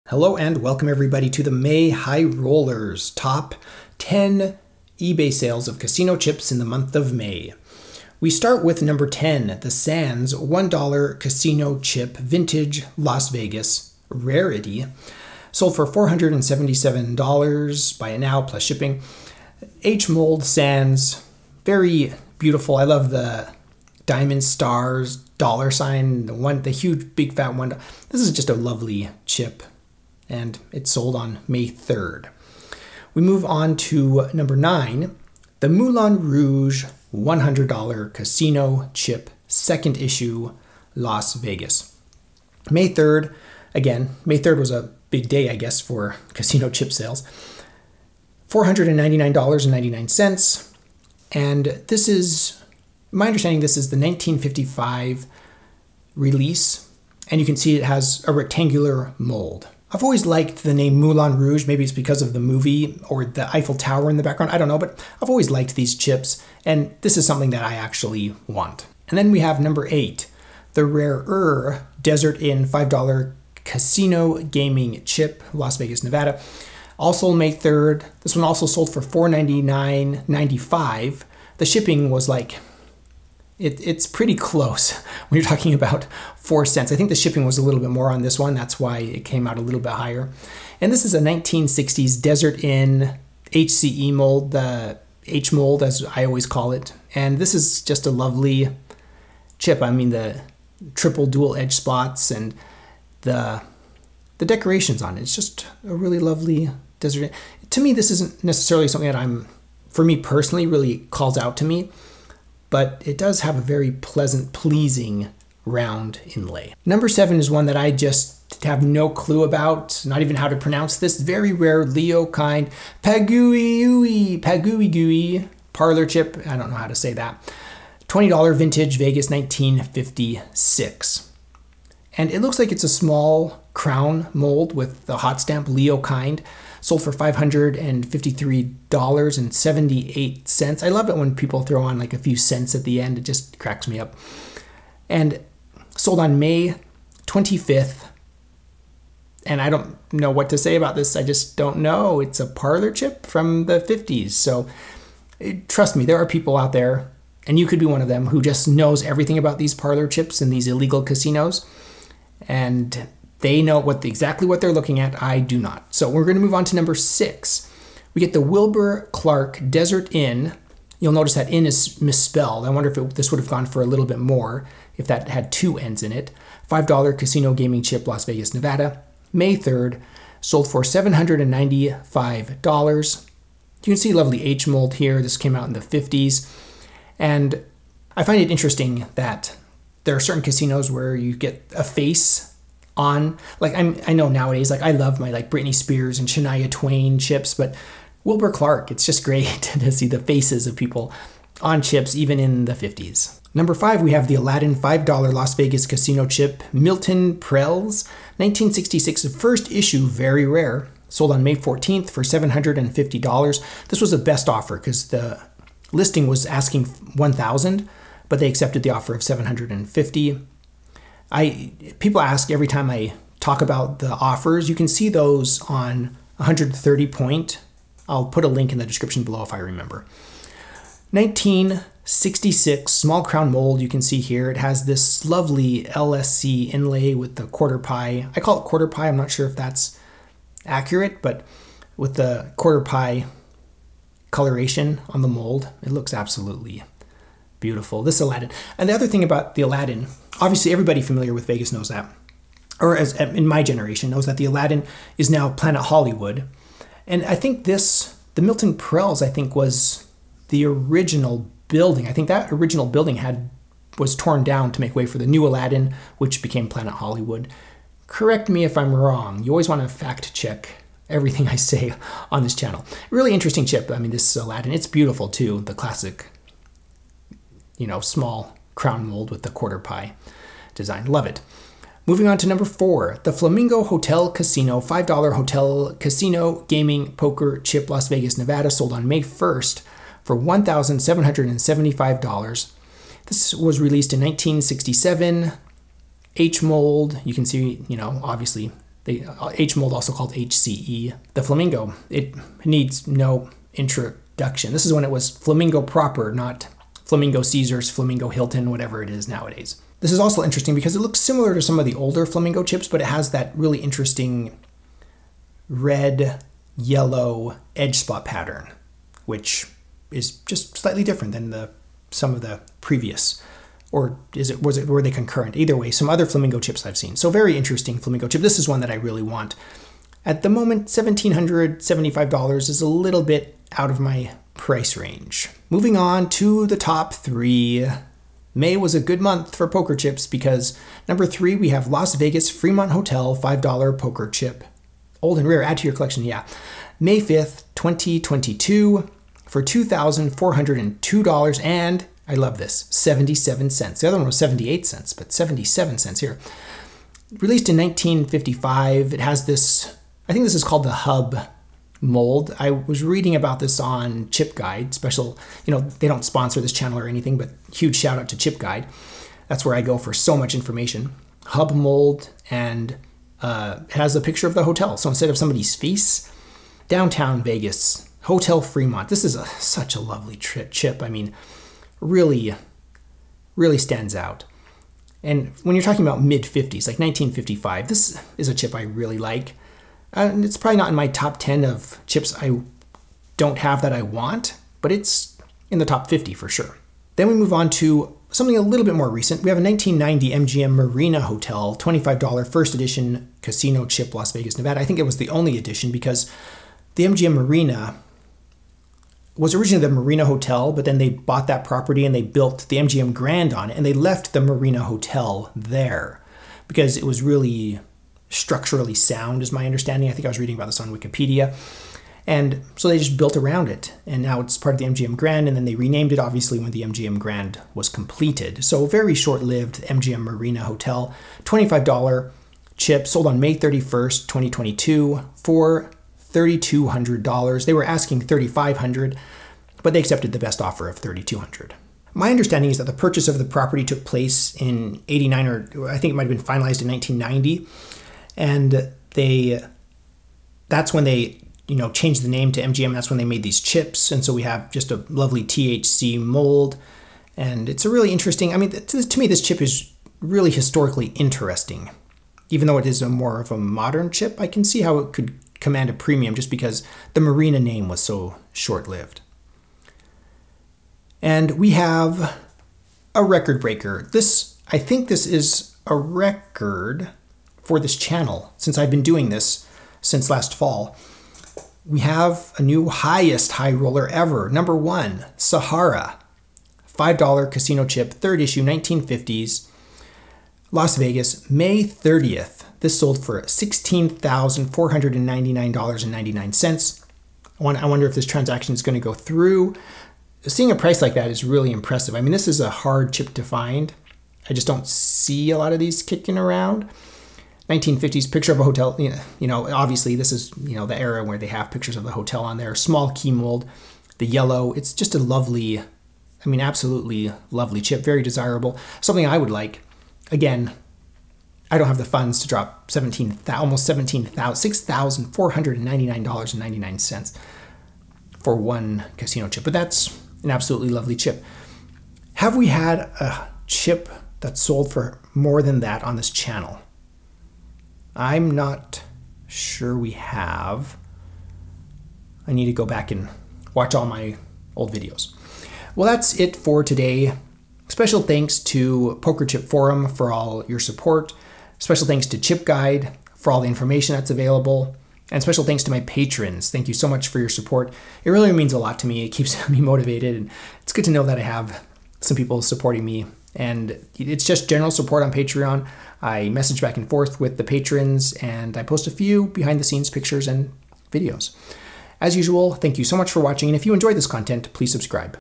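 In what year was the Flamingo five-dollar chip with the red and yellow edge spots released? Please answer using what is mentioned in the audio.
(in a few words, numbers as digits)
1967.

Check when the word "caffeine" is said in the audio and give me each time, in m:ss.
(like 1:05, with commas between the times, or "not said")
not said.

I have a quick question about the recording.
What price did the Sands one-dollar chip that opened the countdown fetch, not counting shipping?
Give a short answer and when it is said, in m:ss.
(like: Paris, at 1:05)
$477, at 0:15.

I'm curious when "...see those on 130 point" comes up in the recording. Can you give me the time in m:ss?
3:44.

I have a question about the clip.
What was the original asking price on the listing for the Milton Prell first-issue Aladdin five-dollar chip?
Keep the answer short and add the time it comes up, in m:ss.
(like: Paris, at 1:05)
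1000, at 3:36.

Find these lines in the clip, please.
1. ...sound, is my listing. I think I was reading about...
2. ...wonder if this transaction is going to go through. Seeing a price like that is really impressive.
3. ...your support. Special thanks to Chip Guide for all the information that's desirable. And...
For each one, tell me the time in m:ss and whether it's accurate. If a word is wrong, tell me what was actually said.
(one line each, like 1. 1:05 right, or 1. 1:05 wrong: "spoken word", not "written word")
1. 6:58 wrong: "understanding", not "listing"
2. 8:17 right
3. 9:10 wrong: "available", not "desirable".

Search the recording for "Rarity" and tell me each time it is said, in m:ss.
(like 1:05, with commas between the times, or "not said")
0:14.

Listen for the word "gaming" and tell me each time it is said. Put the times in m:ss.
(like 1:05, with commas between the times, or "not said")
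1:14, 2:57, 4:46.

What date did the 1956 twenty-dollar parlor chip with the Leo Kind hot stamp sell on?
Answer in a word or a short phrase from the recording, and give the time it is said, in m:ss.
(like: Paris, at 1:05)
May 25th, at 2:26.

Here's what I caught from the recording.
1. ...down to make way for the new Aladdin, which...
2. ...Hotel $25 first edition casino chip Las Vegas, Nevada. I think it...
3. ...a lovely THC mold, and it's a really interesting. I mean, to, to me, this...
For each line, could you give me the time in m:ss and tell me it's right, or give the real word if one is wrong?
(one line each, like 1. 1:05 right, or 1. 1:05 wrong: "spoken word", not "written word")
1. 4:24 right
2. 6:41 right
3. 7:34 right.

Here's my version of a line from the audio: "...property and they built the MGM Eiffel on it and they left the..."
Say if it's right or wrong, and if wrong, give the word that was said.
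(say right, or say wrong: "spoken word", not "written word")
wrong: "Grand", not "Eiffel".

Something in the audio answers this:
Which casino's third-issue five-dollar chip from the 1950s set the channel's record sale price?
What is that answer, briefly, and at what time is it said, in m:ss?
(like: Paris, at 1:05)
Sahara, at 8:05.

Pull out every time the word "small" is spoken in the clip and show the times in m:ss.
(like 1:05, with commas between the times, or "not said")
2:12, 3:52, 4:37, 8:32.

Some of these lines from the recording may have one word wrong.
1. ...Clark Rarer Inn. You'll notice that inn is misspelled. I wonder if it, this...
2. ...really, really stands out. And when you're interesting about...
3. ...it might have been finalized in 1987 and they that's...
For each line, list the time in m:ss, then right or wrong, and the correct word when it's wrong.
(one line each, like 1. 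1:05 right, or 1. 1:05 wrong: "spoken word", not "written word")
1. 2:49 wrong: "Desert", not "Rarer"
2. 6:21 wrong: "talking", not "interesting"
3. 7:26 wrong: "1990", not "1987".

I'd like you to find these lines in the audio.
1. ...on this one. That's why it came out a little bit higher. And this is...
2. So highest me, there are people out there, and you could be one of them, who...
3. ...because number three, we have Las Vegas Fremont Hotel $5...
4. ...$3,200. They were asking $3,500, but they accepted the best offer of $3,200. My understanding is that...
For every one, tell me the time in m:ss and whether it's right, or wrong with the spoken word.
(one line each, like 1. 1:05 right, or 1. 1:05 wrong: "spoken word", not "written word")
1. 1:28 right
2. 2:34 wrong: "trust", not "highest"
3. 5:40 right
4. 7:16 right.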